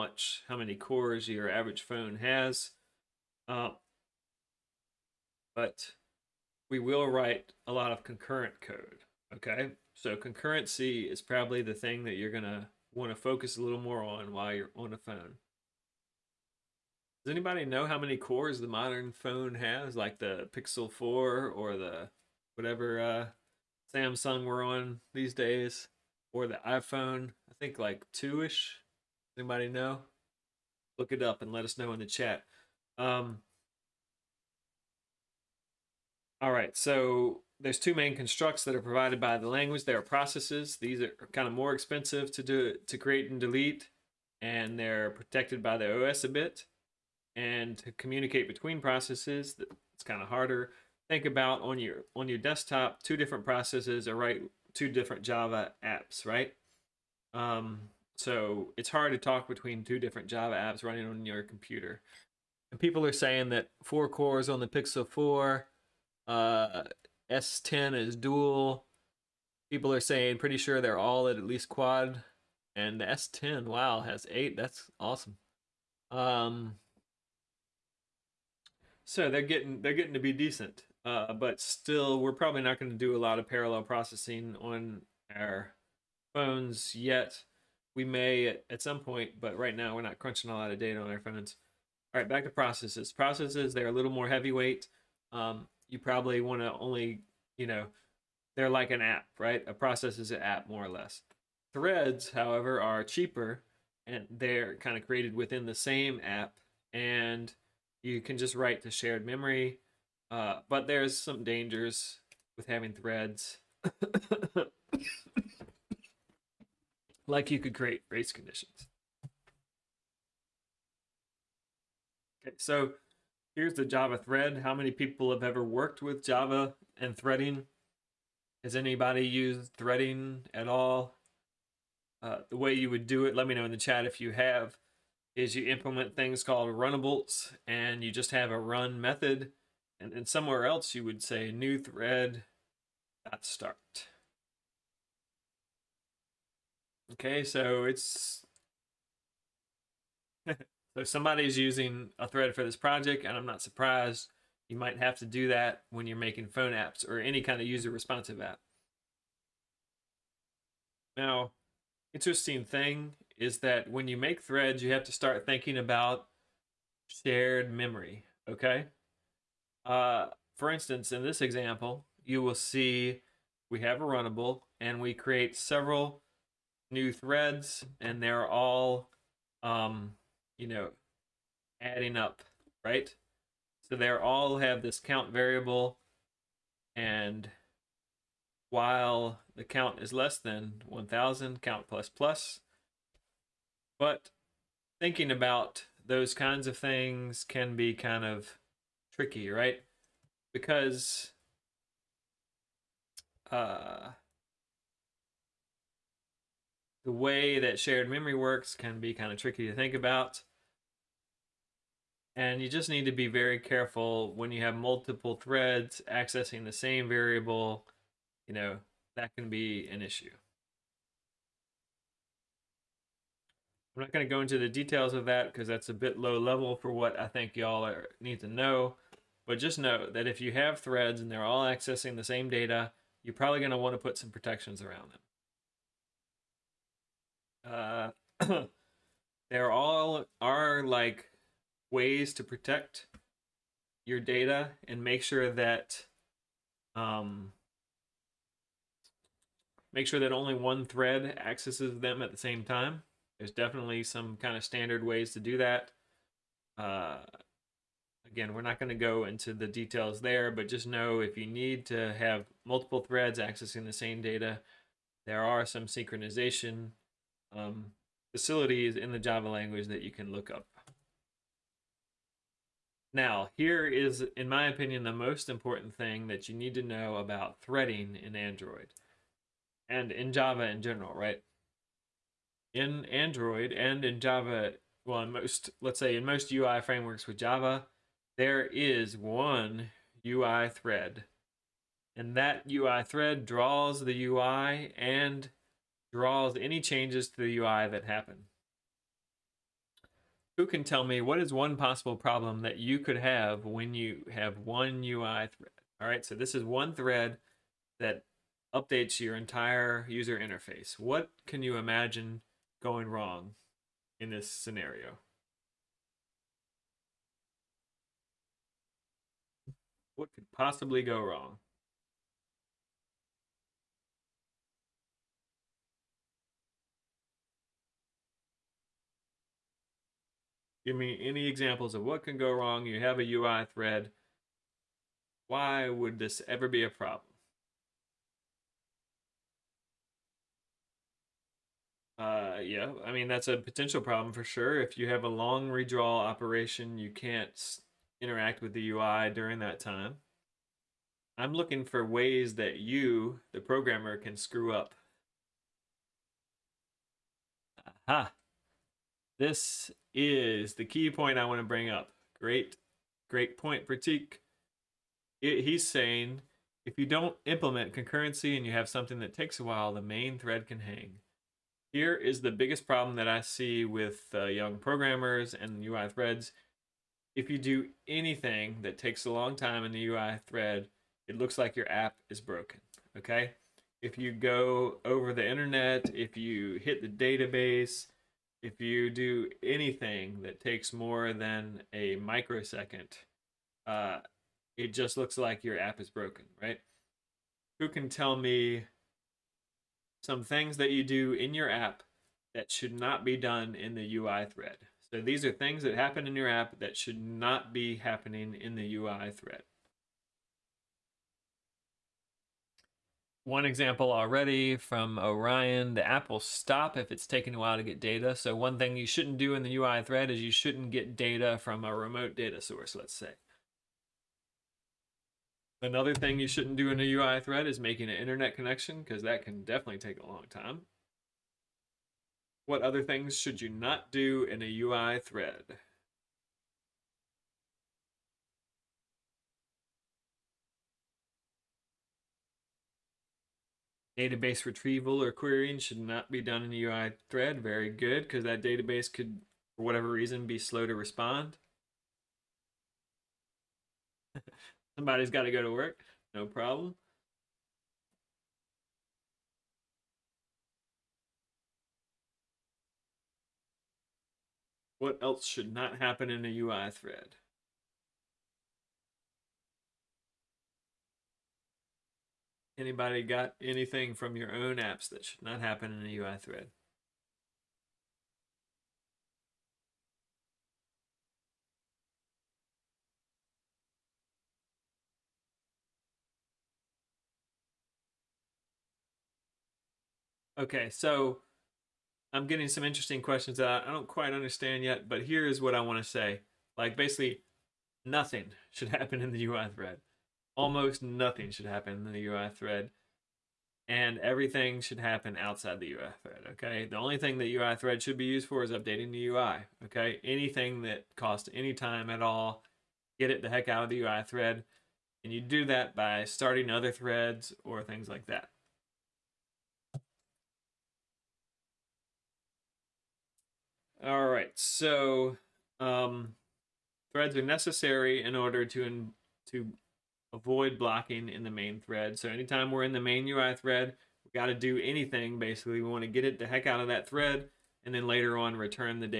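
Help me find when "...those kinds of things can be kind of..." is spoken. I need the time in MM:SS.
03:16.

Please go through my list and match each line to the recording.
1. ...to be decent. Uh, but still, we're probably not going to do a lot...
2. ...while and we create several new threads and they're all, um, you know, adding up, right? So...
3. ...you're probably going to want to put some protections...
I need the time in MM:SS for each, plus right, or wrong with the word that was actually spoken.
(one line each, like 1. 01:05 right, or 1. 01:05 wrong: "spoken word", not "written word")
1. 01:20 right
2. 02:54 wrong: "runnable", not "while"
3. 03:53 right.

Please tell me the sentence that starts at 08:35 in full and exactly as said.
And you do that by starting other threads or things like that.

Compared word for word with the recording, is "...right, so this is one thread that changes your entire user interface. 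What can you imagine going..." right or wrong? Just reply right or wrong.
wrong.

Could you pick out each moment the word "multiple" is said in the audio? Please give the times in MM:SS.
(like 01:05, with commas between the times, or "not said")
03:34, 04:22.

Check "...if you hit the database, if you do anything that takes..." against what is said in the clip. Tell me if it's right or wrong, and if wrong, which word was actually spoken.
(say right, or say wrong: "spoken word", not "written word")
right.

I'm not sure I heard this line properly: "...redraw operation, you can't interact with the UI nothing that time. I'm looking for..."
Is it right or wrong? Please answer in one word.
wrong.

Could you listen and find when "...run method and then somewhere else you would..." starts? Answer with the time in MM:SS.
02:18.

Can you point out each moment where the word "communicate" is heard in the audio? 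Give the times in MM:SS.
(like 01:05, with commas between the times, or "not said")
00:47.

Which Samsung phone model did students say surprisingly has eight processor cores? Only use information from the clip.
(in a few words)
S10.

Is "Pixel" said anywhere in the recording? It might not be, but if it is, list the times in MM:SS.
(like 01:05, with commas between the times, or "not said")
00:20, 01:04.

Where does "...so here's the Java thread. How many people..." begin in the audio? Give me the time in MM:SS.
02:02.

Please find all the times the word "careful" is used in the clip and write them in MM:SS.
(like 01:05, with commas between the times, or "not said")
03:33.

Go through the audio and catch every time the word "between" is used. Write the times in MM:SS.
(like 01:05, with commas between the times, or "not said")
00:48, 00:59.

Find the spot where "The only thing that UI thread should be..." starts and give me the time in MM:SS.
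08:26.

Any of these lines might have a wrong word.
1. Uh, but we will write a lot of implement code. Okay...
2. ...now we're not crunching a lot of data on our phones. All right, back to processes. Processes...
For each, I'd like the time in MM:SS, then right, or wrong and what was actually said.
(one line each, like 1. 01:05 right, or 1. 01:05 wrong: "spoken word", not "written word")
1. 00:03 wrong: "concurrent", not "implement"
2. 01:29 right.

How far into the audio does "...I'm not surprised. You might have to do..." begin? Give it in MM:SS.
02:33.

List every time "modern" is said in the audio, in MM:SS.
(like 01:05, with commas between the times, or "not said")
00:18.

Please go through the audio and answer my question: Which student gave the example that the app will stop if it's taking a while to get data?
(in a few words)
Orion.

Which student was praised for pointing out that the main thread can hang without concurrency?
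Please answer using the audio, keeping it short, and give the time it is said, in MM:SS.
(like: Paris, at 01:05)
Pratik, at 06:03.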